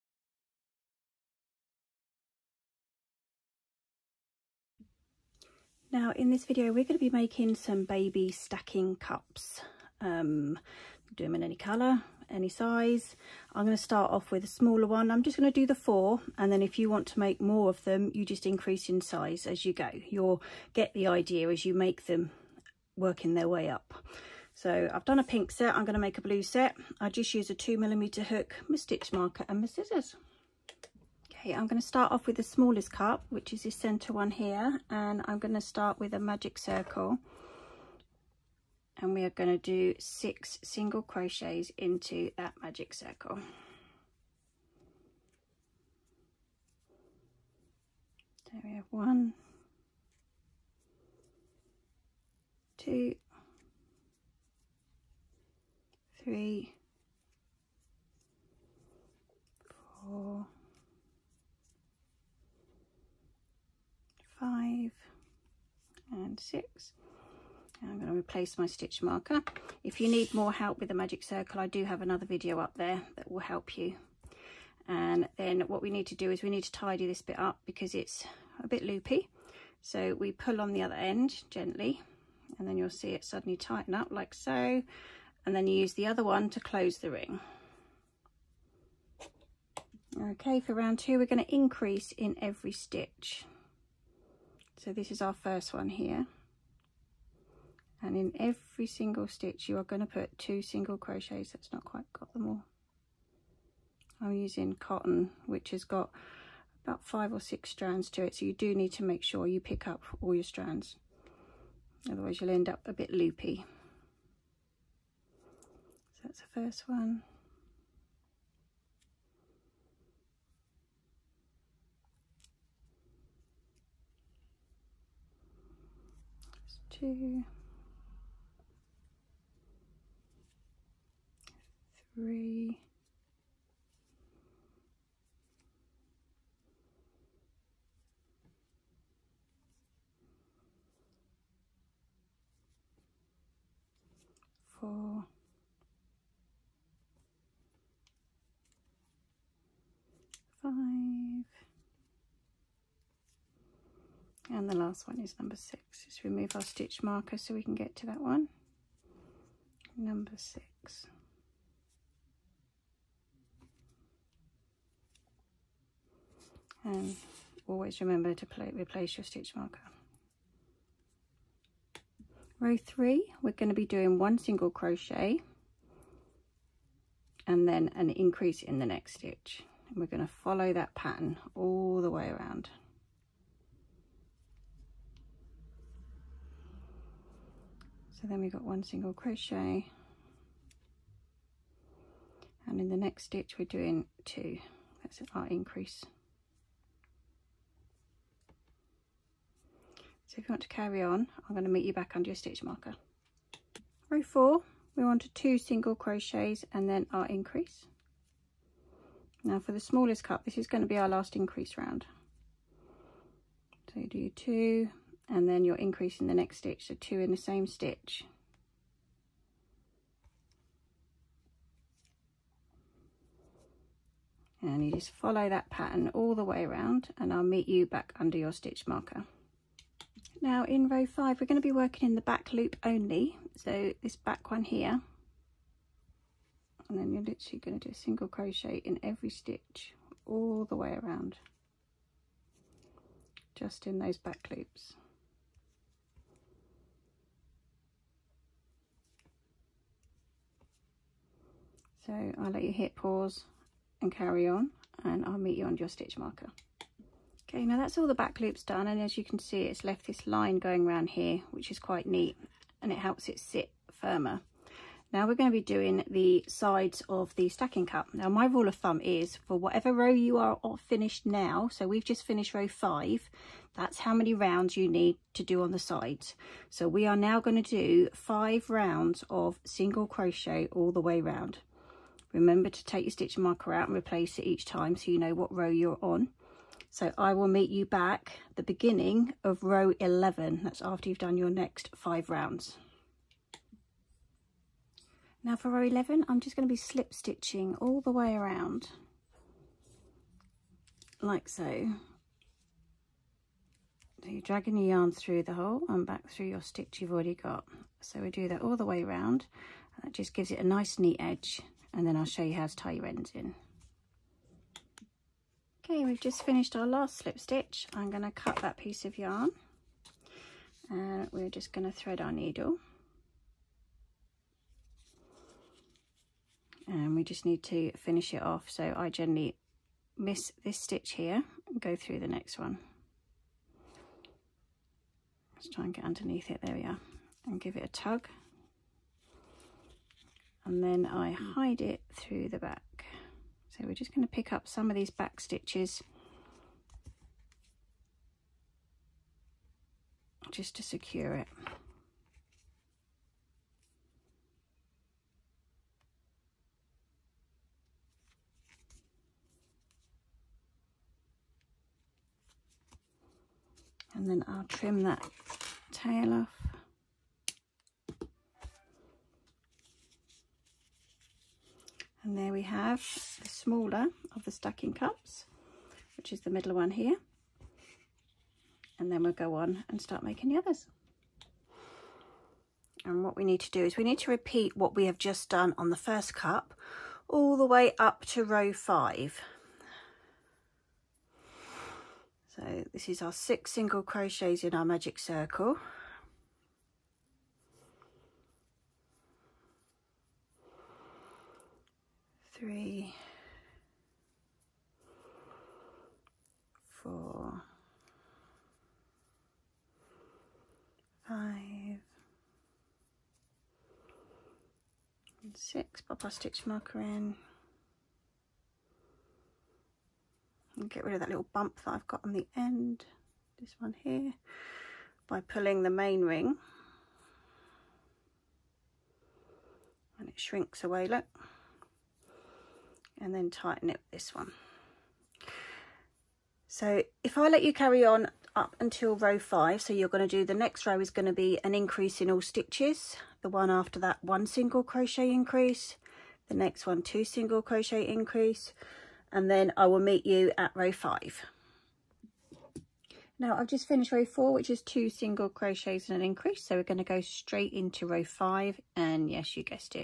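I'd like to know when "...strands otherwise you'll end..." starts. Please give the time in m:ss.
1:50.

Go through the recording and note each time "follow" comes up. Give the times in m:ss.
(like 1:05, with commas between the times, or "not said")
3:00, 3:45.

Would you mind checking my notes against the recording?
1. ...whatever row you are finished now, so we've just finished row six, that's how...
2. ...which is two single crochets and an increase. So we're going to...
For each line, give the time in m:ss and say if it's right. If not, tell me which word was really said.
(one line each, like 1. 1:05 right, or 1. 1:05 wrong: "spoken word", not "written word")
1. 4:29 wrong: "five", not "six"
2. 7:34 right.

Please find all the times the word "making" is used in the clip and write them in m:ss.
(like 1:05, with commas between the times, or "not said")
0:07, 6:20.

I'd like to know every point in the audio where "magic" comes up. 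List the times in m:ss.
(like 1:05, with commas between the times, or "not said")
0:36, 0:42, 1:10, 6:34.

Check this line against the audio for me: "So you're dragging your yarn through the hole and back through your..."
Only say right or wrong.
right.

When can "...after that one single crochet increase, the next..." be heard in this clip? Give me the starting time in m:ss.
7:23.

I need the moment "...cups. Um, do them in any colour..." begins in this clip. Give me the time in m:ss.
0:08.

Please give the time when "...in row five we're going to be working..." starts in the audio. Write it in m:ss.
3:50.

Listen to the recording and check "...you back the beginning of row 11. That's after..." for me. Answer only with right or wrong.
right.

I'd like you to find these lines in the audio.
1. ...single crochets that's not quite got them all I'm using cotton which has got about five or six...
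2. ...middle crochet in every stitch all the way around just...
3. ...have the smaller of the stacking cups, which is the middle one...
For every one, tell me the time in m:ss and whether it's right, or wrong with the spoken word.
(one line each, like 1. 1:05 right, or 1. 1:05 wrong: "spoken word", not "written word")
1. 1:40 right
2. 3:57 wrong: "single", not "middle"
3. 6:12 right.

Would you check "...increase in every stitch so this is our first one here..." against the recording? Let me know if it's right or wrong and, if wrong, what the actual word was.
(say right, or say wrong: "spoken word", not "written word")
right.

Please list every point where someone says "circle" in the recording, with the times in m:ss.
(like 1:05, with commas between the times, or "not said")
0:36, 0:42, 1:11, 6:35.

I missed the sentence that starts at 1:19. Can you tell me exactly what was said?
So we pull on the other end gently and then you'll see it suddenly tighten up like so.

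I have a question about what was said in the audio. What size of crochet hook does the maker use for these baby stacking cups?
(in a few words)
2 millimeter.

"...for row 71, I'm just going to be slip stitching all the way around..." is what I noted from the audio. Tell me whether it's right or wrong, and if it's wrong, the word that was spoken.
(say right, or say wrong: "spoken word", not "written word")
wrong: "11", not "71".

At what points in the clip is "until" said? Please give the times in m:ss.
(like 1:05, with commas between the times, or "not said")
7:18.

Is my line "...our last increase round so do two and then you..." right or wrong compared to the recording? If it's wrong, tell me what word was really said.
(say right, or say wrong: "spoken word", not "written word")
right.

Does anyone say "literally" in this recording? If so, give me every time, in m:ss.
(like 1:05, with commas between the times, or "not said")
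3:57.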